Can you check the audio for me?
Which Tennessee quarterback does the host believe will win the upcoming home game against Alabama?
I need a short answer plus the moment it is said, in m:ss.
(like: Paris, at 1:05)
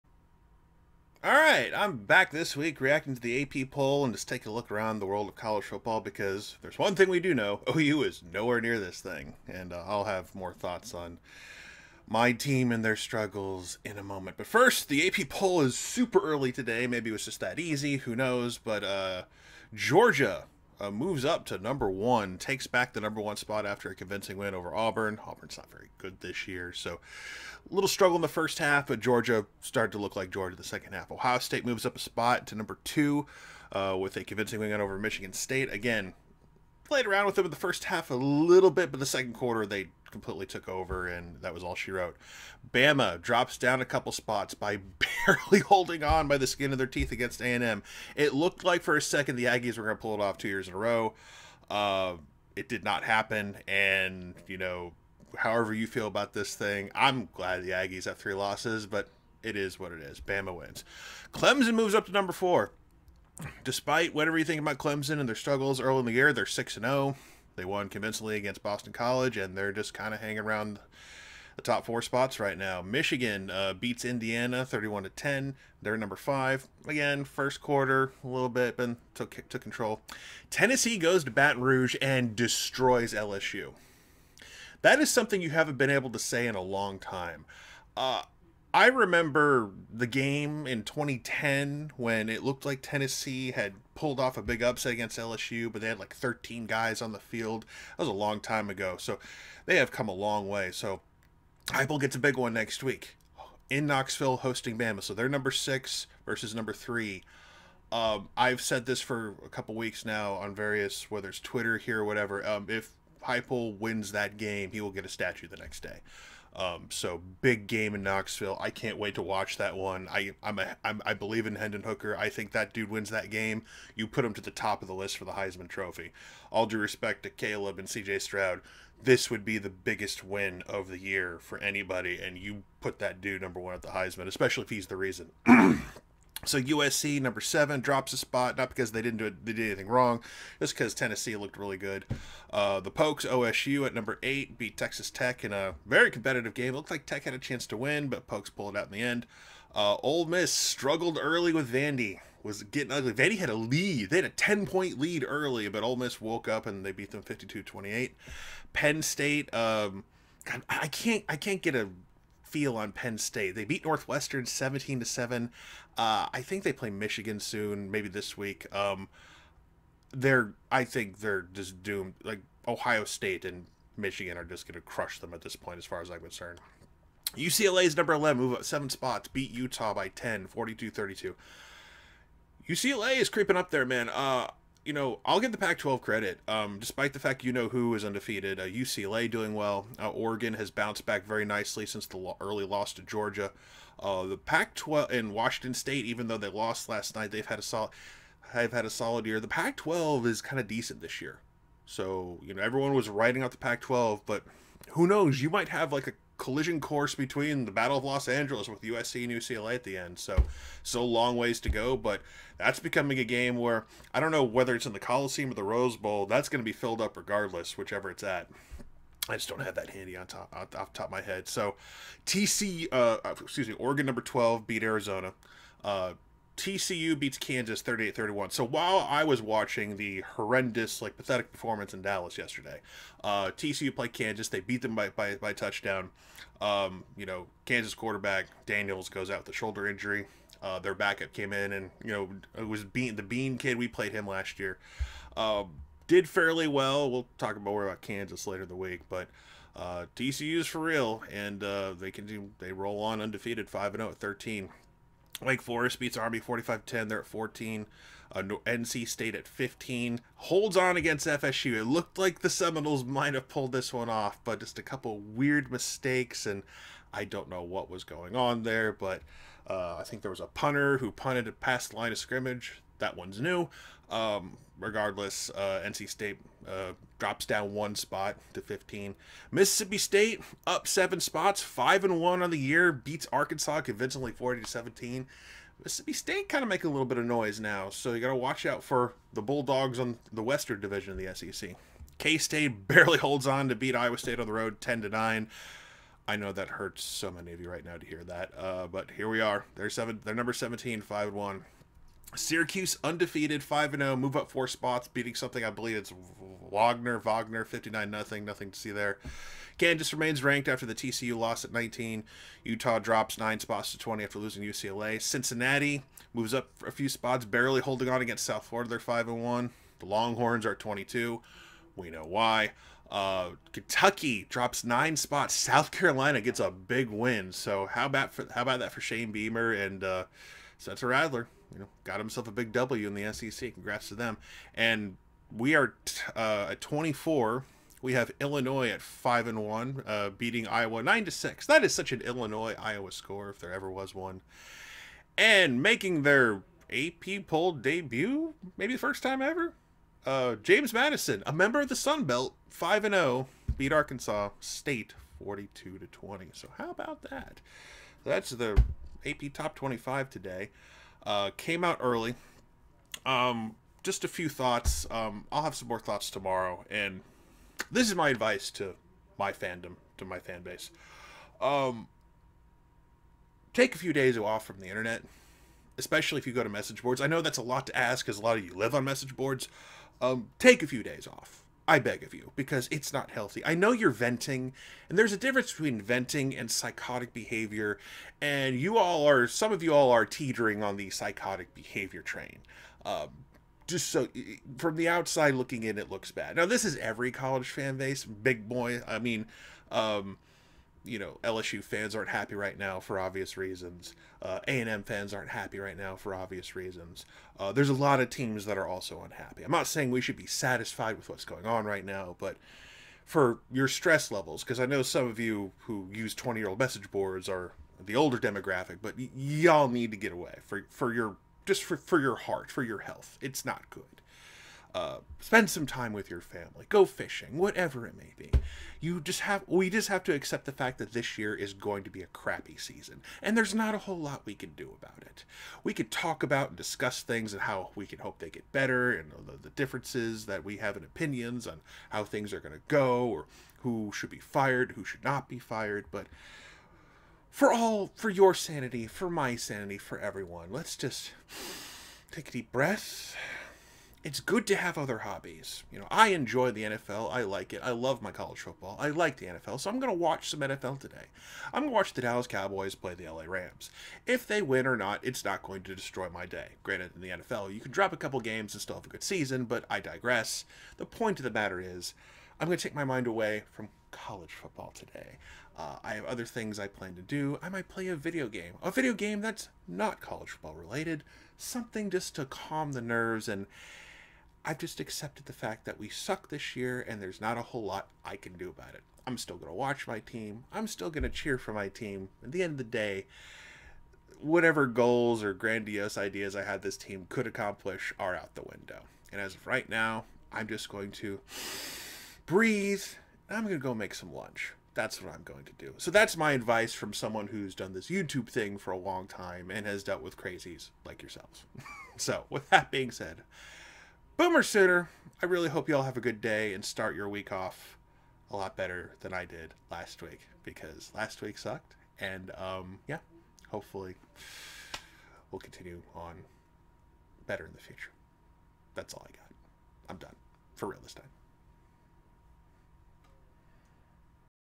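Hendon Hooker, at 2:01.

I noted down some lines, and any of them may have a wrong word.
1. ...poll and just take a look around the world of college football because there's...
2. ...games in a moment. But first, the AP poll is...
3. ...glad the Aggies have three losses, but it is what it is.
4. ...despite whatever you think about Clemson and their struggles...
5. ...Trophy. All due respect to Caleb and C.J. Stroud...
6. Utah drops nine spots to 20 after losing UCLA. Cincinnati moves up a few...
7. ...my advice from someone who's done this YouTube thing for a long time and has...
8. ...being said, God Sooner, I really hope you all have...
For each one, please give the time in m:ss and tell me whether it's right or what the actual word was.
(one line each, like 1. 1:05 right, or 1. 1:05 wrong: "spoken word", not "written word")
1. 0:03 right
2. 0:12 wrong: "struggles", not "games"
3. 0:57 right
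4. 1:03 right
5. 2:05 right
6. 5:12 right
7. 8:26 right
8. 8:32 wrong: "Boomer", not "God".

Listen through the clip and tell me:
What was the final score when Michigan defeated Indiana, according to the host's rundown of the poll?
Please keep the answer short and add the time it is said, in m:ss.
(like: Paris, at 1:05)
31-10, at 1:14.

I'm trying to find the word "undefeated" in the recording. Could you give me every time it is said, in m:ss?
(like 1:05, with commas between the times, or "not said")
3:08, 4:13, 5:03.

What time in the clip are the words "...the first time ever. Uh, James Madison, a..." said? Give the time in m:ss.
5:48.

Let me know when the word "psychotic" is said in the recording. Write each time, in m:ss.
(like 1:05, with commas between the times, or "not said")
6:26, 6:31.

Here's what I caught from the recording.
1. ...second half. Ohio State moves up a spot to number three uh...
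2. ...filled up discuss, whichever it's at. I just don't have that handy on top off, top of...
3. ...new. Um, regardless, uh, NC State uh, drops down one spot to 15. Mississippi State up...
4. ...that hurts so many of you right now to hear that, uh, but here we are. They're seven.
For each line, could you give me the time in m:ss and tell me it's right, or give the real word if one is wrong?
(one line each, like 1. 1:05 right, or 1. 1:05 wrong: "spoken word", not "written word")
1. 0:30 wrong: "two", not "three"
2. 3:36 wrong: "regardless", not "discuss"
3. 4:33 right
4. 4:56 right.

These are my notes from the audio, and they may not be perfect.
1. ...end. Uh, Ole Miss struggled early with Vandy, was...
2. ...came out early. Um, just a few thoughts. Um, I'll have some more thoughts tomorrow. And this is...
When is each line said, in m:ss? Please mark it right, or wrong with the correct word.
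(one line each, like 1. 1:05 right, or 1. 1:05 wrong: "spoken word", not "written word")
1. 2:29 right
2. 6:01 right.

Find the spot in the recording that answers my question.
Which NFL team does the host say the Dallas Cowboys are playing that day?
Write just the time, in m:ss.
7:43.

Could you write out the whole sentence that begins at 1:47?
Um, I've said this for a couple weeks now on various, whether it's Twitter here or whatever.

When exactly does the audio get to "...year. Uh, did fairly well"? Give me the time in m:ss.
4:04.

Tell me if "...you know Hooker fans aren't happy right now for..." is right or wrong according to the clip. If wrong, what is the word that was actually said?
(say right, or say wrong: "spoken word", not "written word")
wrong: "LSU", not "Hooker".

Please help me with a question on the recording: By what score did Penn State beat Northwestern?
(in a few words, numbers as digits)
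17-7.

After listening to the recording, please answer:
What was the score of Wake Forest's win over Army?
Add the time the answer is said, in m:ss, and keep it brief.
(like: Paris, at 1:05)
45-10, at 4:16.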